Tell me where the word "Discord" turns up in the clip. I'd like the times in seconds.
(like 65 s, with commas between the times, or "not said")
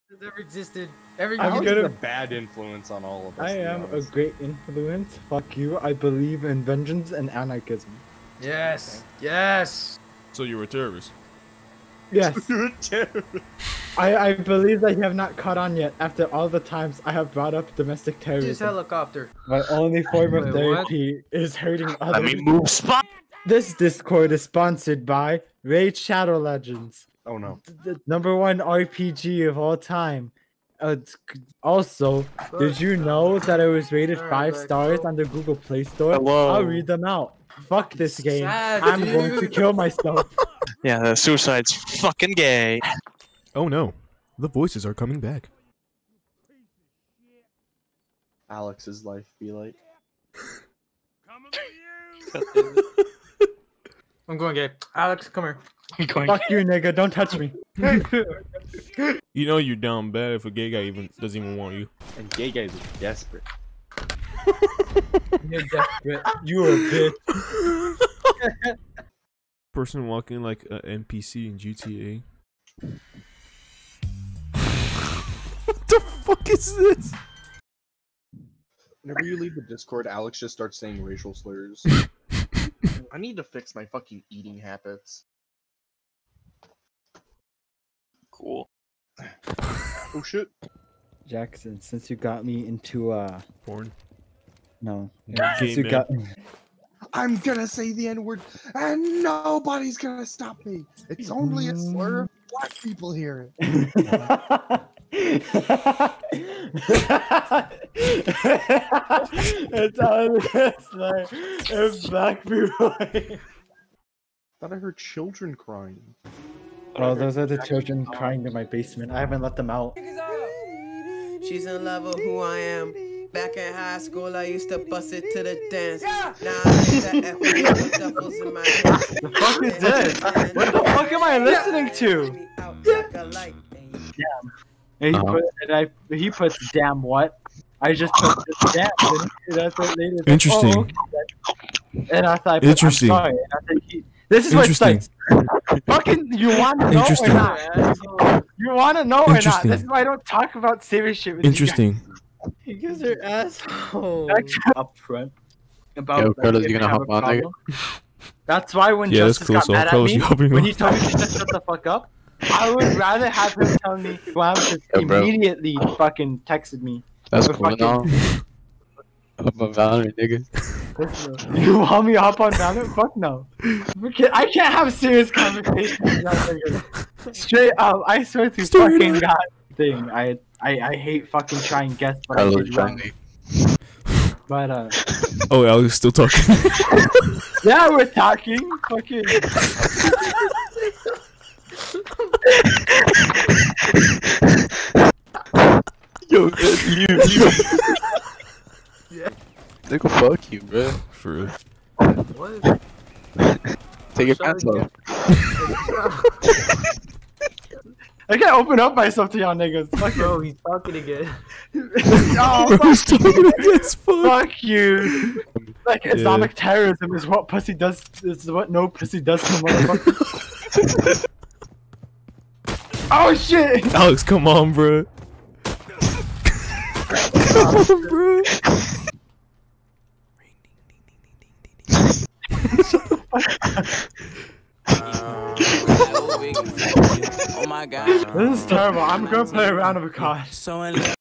23 s, 79 s.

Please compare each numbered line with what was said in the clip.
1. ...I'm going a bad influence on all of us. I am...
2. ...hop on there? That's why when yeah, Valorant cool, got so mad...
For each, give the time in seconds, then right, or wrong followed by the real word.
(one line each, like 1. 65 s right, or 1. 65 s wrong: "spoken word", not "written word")
1. 1 s right
2. 156 s wrong: "Justice", not "Valorant".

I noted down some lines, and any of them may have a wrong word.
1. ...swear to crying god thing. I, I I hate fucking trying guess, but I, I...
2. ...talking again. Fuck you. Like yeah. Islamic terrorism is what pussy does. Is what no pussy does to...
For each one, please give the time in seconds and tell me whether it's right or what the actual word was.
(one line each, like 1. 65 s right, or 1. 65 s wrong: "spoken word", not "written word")
1. 178 s wrong: "fucking", not "crying"
2. 213 s right.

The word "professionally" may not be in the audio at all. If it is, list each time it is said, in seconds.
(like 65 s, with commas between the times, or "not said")
not said.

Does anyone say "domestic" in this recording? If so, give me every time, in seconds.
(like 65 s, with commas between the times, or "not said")
17 s.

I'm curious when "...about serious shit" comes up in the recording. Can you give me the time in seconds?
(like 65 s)
150 s.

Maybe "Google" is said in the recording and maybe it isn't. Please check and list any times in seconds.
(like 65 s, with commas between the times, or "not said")
35 s.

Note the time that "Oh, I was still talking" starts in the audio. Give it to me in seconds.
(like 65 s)
185 s.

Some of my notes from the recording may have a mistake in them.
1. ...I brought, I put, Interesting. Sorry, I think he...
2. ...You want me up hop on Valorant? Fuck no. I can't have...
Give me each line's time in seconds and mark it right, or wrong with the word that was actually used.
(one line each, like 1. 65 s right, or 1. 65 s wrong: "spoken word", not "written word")
1. 142 s wrong: "thought", not "brought"
2. 171 s right.